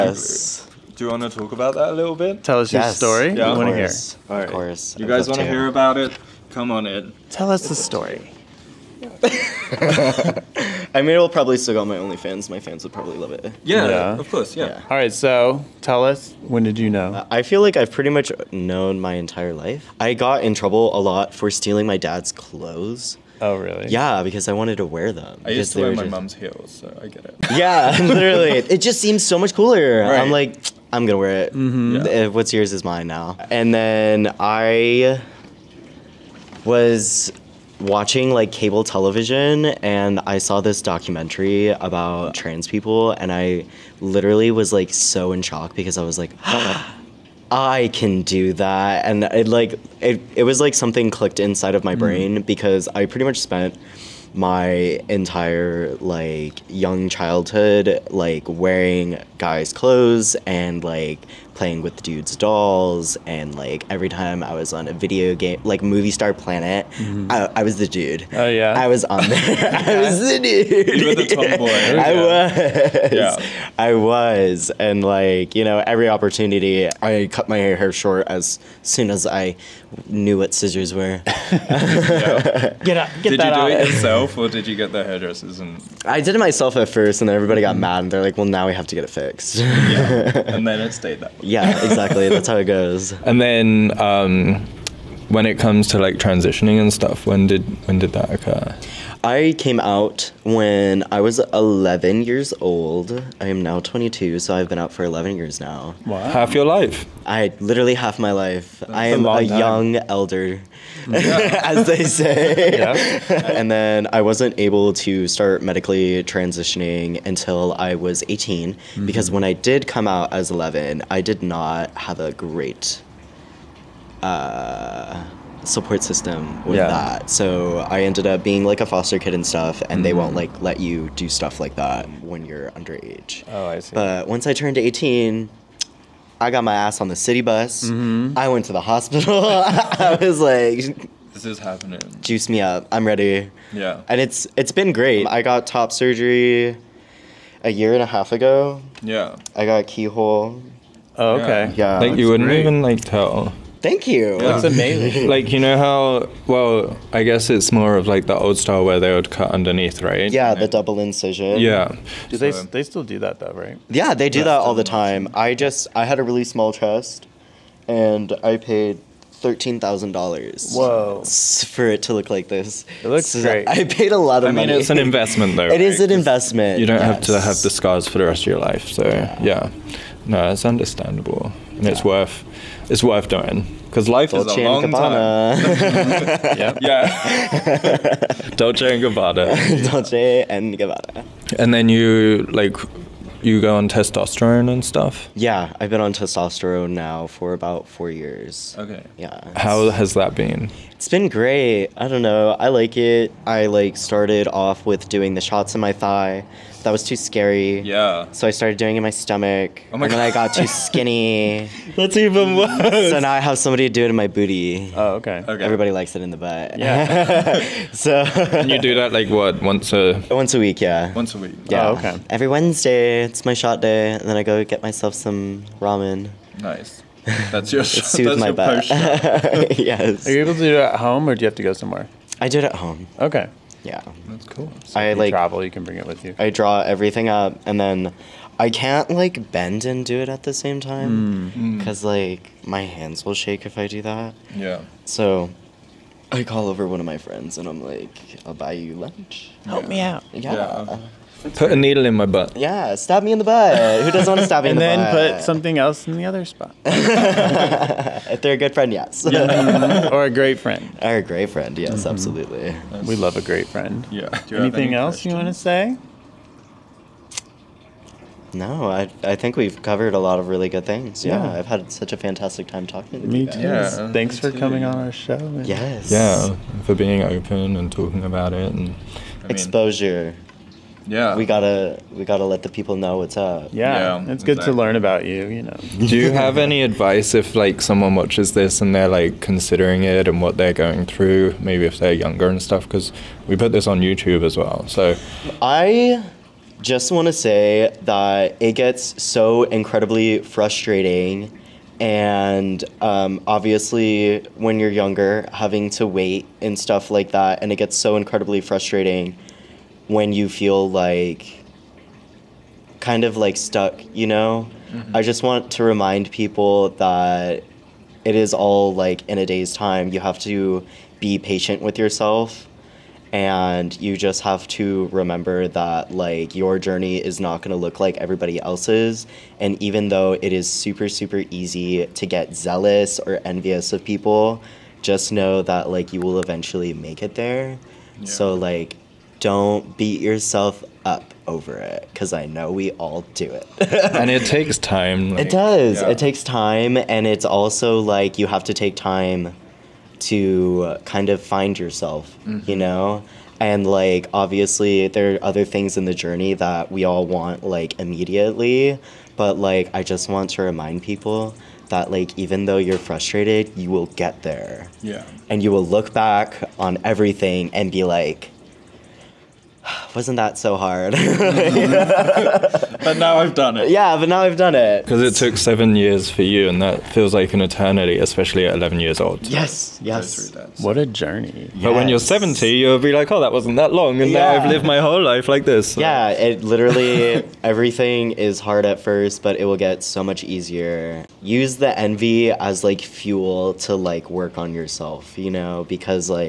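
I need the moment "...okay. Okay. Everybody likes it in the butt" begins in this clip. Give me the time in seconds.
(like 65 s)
215 s.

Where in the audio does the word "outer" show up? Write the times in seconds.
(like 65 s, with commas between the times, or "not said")
not said.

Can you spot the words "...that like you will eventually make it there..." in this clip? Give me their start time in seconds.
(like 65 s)
335 s.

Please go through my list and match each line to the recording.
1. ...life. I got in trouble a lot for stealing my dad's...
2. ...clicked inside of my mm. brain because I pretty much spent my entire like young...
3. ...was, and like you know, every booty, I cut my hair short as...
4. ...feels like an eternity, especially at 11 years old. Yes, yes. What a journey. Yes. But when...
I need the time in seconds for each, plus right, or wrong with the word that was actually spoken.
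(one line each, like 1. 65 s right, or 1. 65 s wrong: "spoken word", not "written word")
1. 19 s right
2. 51 s right
3. 73 s wrong: "opportunity", not "booty"
4. 377 s right.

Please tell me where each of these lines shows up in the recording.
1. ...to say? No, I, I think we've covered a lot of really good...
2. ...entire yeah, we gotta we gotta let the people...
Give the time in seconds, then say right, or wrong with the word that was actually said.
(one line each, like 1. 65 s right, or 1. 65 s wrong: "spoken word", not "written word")
1. 265 s right
2. 279 s wrong: "exposure", not "entire".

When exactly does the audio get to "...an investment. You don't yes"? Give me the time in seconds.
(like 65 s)
176 s.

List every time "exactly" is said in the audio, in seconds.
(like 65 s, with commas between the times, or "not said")
91 s, 284 s.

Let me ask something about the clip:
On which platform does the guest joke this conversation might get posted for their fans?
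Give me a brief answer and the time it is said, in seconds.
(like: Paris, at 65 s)
OnlyFans, at 11 s.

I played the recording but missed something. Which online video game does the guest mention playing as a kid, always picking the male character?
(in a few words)
Movie Star Planet.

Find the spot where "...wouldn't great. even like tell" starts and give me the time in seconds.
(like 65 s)
152 s.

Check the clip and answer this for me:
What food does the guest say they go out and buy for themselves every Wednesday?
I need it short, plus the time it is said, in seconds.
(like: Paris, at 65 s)
ramen, at 225 s.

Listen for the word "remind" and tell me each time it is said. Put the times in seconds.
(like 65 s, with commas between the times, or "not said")
315 s, 360 s.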